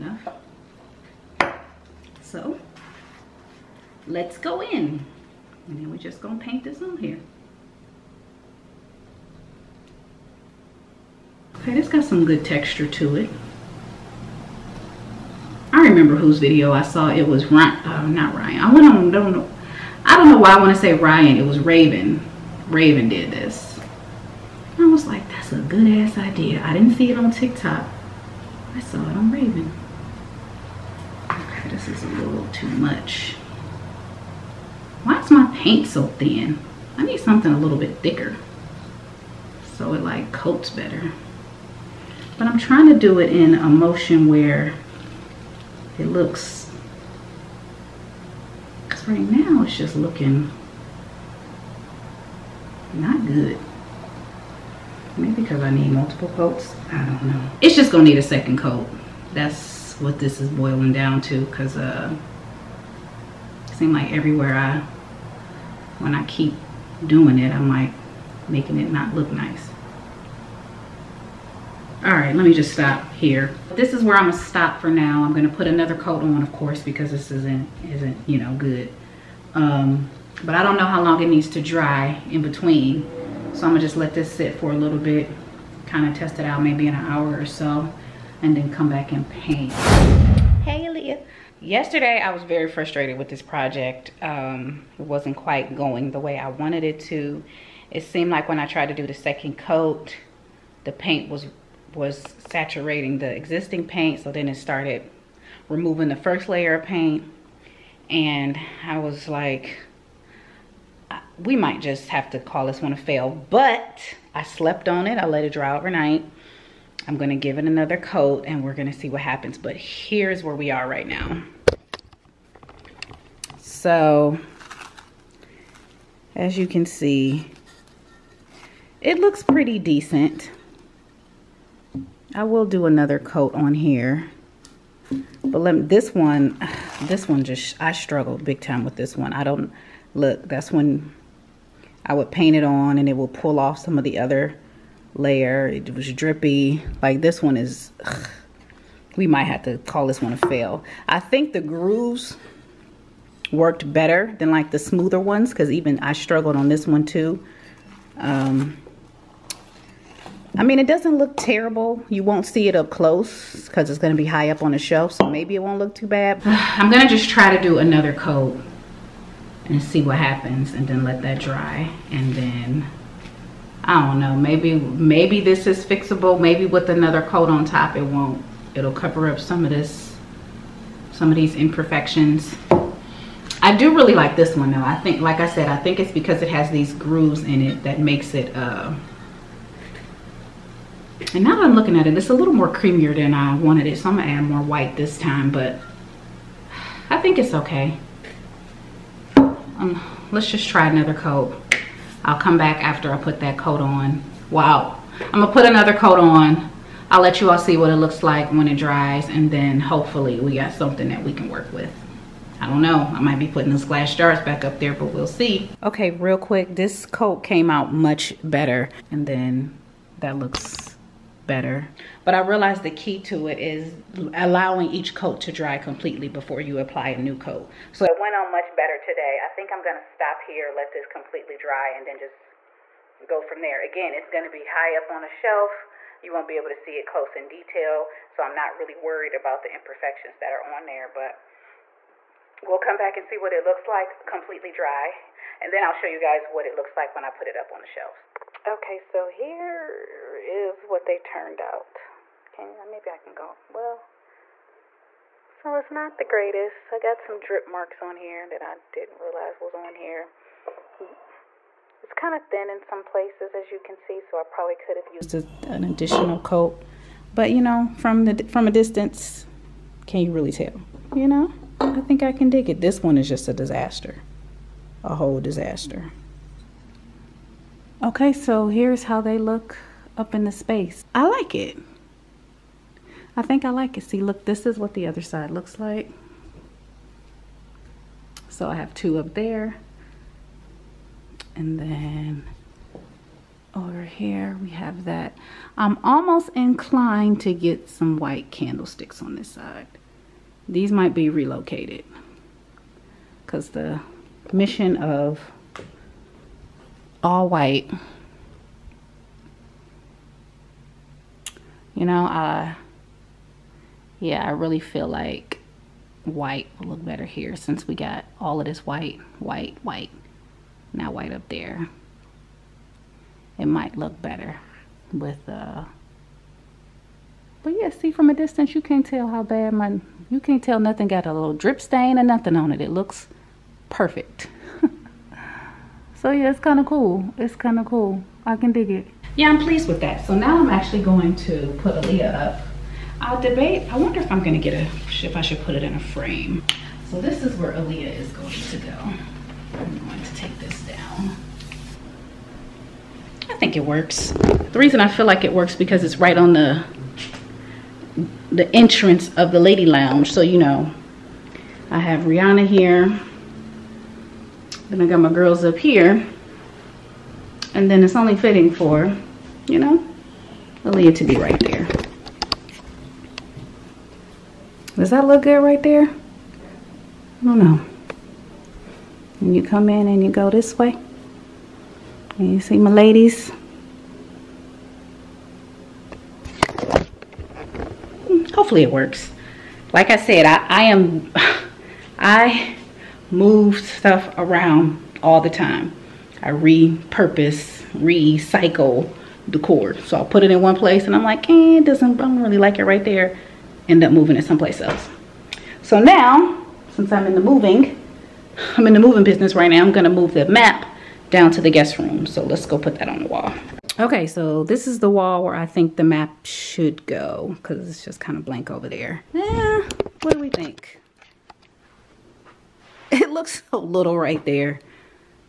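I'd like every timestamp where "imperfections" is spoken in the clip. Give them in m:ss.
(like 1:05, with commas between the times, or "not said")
3:01, 3:59.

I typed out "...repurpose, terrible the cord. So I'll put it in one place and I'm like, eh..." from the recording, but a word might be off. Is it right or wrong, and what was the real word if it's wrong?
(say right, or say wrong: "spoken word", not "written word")
wrong: "recycle", not "terrible".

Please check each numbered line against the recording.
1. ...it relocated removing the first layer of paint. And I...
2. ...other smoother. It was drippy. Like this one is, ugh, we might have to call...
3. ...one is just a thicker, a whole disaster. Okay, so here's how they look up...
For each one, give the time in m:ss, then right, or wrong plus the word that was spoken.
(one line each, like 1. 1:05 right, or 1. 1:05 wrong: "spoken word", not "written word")
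1. 1:44 wrong: "started", not "relocated"
2. 2:24 wrong: "layer", not "smoother"
3. 4:33 wrong: "disaster", not "thicker".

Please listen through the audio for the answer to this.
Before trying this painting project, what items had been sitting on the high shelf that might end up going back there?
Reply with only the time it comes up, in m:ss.
3:33.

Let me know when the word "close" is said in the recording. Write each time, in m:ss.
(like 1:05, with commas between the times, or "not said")
2:42, 3:57.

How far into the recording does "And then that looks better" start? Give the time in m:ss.
3:39.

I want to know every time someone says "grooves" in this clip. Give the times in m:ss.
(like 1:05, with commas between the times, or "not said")
2:31, 3:06.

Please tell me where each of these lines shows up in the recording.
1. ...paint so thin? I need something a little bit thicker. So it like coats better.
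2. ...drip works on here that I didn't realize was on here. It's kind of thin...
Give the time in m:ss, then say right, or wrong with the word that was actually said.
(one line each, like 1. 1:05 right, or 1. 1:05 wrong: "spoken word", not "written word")
1. 0:35 right
2. 4:17 wrong: "marks", not "works".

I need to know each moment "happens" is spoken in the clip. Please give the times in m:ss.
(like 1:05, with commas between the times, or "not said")
1:59, 2:50.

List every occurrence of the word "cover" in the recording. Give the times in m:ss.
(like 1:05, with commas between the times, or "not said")
2:58.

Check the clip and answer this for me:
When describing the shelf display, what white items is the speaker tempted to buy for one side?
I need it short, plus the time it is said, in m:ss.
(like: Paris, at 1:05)
white candlesticks, at 4:58.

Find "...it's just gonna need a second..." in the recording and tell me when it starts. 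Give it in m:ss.
0:57.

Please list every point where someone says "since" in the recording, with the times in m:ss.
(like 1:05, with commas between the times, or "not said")
5:17, 6:46.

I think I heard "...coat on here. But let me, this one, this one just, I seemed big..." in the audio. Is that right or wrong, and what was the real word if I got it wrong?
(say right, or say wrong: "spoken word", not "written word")
wrong: "struggled", not "seemed".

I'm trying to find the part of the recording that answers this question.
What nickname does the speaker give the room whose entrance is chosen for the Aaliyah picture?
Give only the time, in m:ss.
5:59.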